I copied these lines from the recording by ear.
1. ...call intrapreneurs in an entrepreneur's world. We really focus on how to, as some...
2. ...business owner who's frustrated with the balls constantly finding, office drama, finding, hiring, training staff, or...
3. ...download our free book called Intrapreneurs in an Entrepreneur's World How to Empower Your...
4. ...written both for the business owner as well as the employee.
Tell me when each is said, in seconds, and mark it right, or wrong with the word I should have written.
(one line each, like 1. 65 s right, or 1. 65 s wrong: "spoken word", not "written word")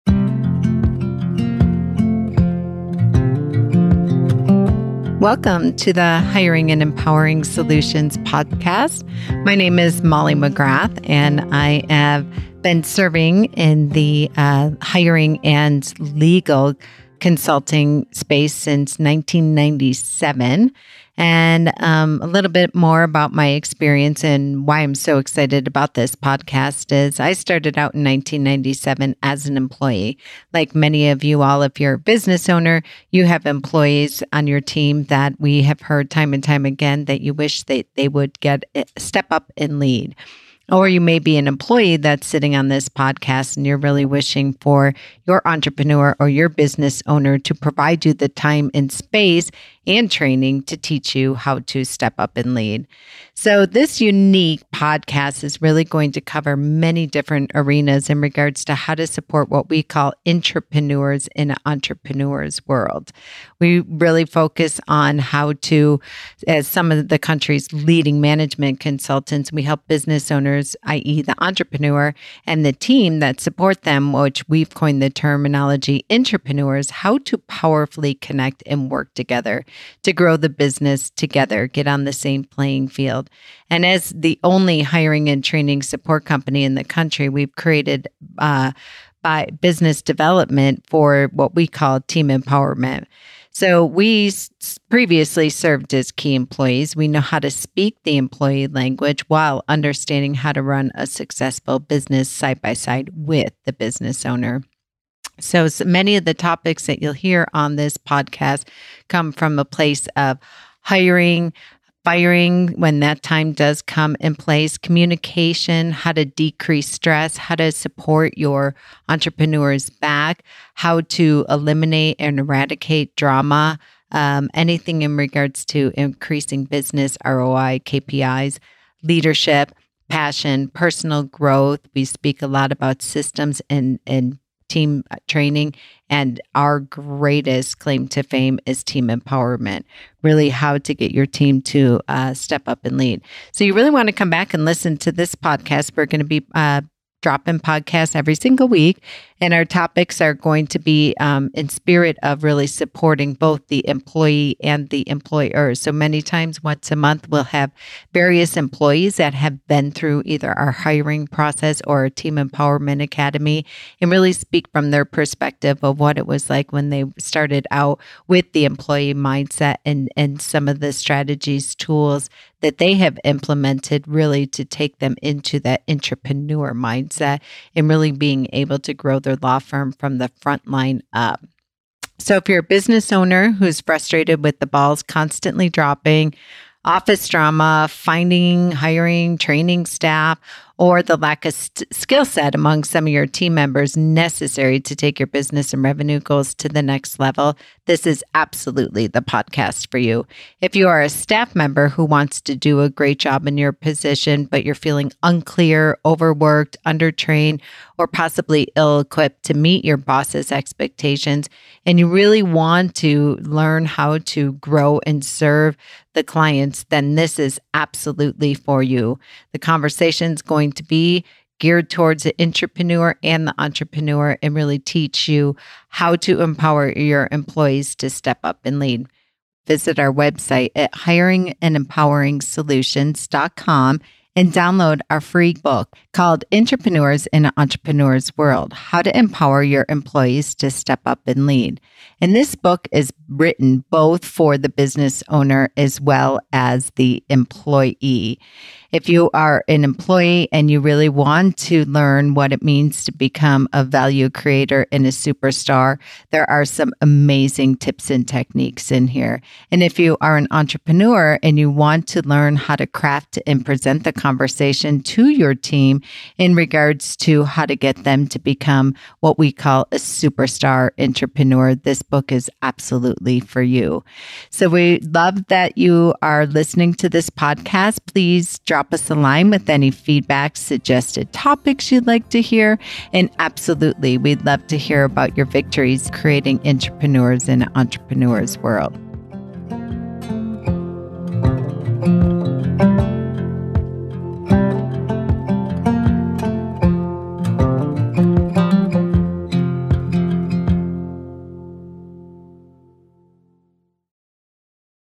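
1. 59 s right
2. 182 s wrong: "dropping", not "finding"
3. 234 s right
4. 243 s right.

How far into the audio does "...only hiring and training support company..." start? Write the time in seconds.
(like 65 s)
84 s.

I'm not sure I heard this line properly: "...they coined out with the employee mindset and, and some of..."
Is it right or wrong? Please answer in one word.
wrong.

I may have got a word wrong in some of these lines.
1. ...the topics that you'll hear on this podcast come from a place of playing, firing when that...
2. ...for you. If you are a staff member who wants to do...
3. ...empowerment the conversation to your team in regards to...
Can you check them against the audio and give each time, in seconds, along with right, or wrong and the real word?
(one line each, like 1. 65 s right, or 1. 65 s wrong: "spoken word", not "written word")
1. 106 s wrong: "hiring", not "playing"
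2. 199 s right
3. 263 s wrong: "present", not "empowerment".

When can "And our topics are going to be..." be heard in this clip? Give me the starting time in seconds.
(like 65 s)
149 s.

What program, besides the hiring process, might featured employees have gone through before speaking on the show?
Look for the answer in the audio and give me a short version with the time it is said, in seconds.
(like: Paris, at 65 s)
Team Empowerment Academy, at 162 s.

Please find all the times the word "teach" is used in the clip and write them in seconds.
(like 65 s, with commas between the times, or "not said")
50 s, 224 s.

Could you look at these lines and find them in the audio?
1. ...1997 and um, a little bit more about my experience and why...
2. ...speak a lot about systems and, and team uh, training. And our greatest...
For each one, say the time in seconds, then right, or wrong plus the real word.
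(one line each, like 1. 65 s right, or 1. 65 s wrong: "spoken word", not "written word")
1. 18 s right
2. 132 s right.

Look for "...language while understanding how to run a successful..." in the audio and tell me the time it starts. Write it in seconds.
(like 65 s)
98 s.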